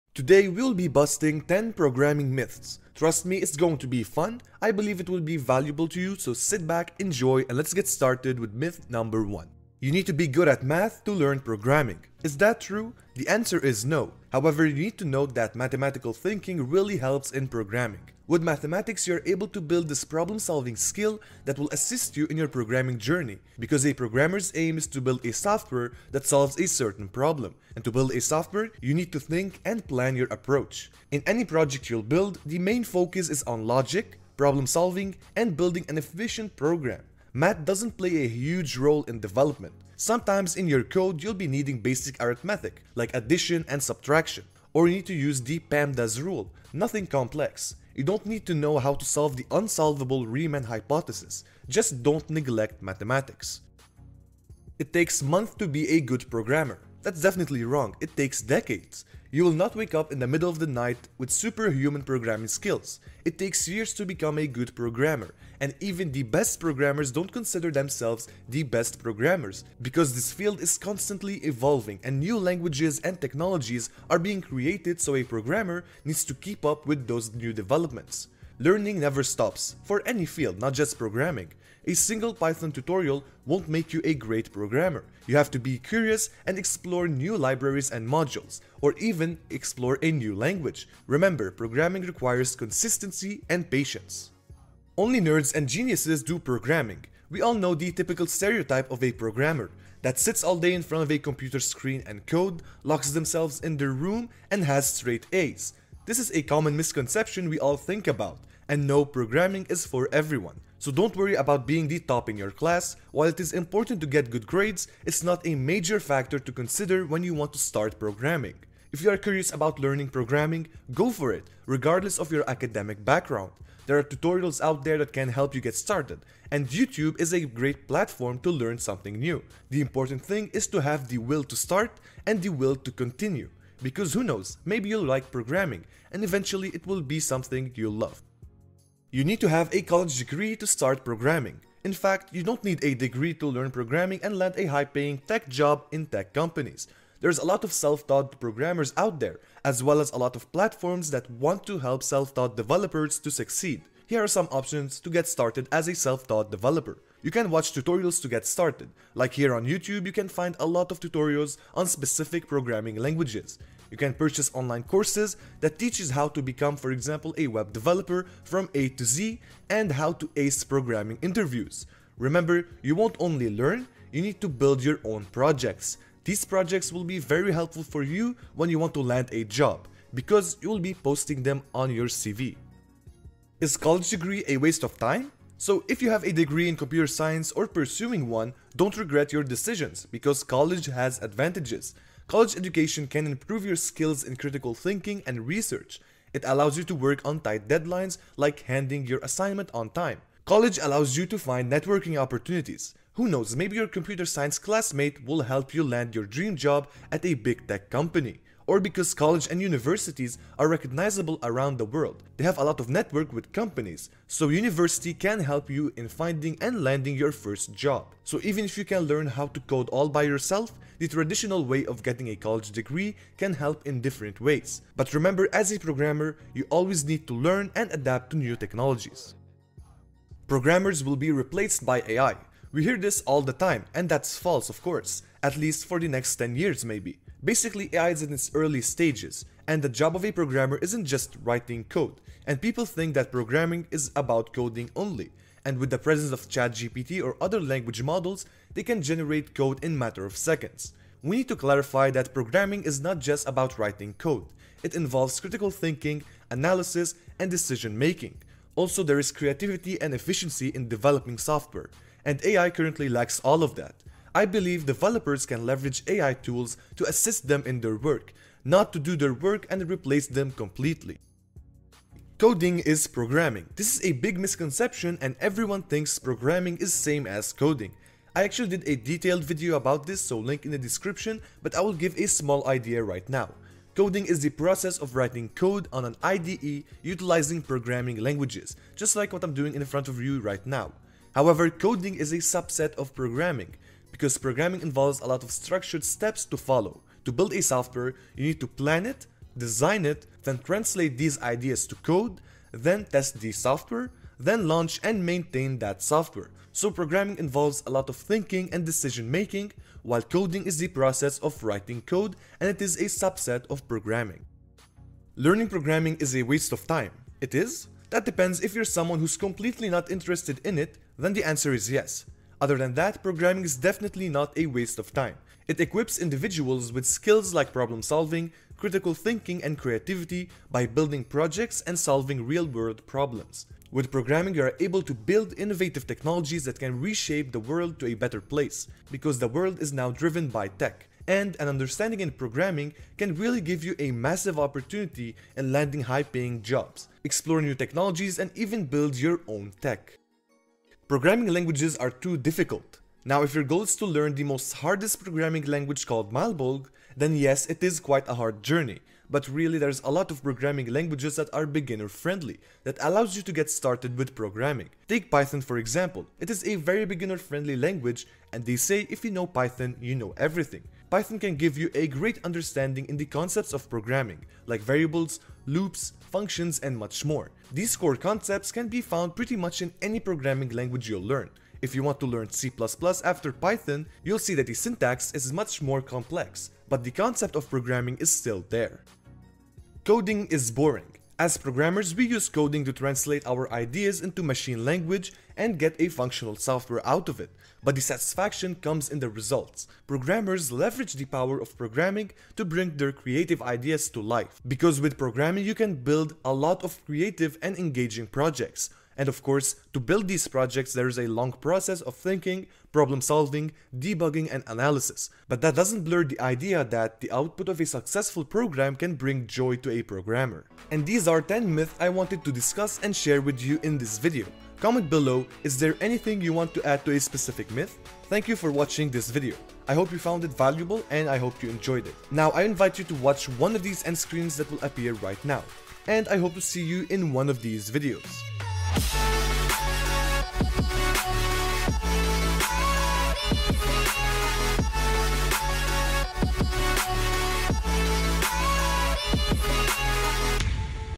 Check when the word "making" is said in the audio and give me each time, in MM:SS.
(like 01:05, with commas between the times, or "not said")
04:17, 05:09.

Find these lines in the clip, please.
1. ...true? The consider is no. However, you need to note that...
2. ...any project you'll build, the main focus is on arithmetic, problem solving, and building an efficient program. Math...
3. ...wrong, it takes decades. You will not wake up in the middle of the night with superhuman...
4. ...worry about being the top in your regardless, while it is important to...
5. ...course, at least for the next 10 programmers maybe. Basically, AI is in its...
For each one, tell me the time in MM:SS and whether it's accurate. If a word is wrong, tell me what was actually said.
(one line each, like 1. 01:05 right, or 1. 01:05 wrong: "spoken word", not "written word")
1. 00:12 wrong: "answer", not "consider"
2. 00:31 wrong: "logic", not "arithmetic"
3. 00:57 right
4. 01:51 wrong: "class", not "regardless"
5. 03:54 wrong: "years", not "programmers".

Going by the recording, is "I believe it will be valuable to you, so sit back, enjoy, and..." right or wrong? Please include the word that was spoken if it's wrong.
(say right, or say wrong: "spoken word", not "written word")
right.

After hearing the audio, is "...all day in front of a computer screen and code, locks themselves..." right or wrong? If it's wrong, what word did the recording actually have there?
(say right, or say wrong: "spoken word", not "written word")
right.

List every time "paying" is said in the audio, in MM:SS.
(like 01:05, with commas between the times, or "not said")
02:24, 05:46.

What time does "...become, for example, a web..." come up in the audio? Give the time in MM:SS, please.
02:46.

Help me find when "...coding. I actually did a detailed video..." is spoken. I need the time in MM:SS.
04:37.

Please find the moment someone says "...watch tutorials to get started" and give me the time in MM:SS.
02:37.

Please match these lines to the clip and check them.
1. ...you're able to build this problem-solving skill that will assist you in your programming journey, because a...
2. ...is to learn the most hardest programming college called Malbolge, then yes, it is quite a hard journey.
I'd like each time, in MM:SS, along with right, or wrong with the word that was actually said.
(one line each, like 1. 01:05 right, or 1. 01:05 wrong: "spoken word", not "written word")
1. 00:19 right
2. 05:53 wrong: "language", not "college".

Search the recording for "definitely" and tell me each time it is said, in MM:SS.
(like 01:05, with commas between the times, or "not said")
00:57, 05:23.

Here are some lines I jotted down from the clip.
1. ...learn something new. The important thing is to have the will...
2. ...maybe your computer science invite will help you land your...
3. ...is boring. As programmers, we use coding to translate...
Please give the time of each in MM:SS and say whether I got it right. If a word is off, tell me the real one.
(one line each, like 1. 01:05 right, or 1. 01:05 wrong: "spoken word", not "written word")
1. 02:08 right
2. 03:23 wrong: "classmate", not "invite"
3. 06:30 right.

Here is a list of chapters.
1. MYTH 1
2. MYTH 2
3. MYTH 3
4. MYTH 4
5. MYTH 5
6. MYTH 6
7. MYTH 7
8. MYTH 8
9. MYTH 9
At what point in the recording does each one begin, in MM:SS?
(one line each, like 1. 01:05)
1. 00:10
2. 00:54
3. 01:35
4. 02:18
5. 03:04
6. 03:50
7. 04:33
8. 05:14
9. 05:51.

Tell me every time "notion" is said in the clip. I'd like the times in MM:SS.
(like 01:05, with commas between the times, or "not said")
not said.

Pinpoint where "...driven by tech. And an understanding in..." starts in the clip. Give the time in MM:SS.
05:40.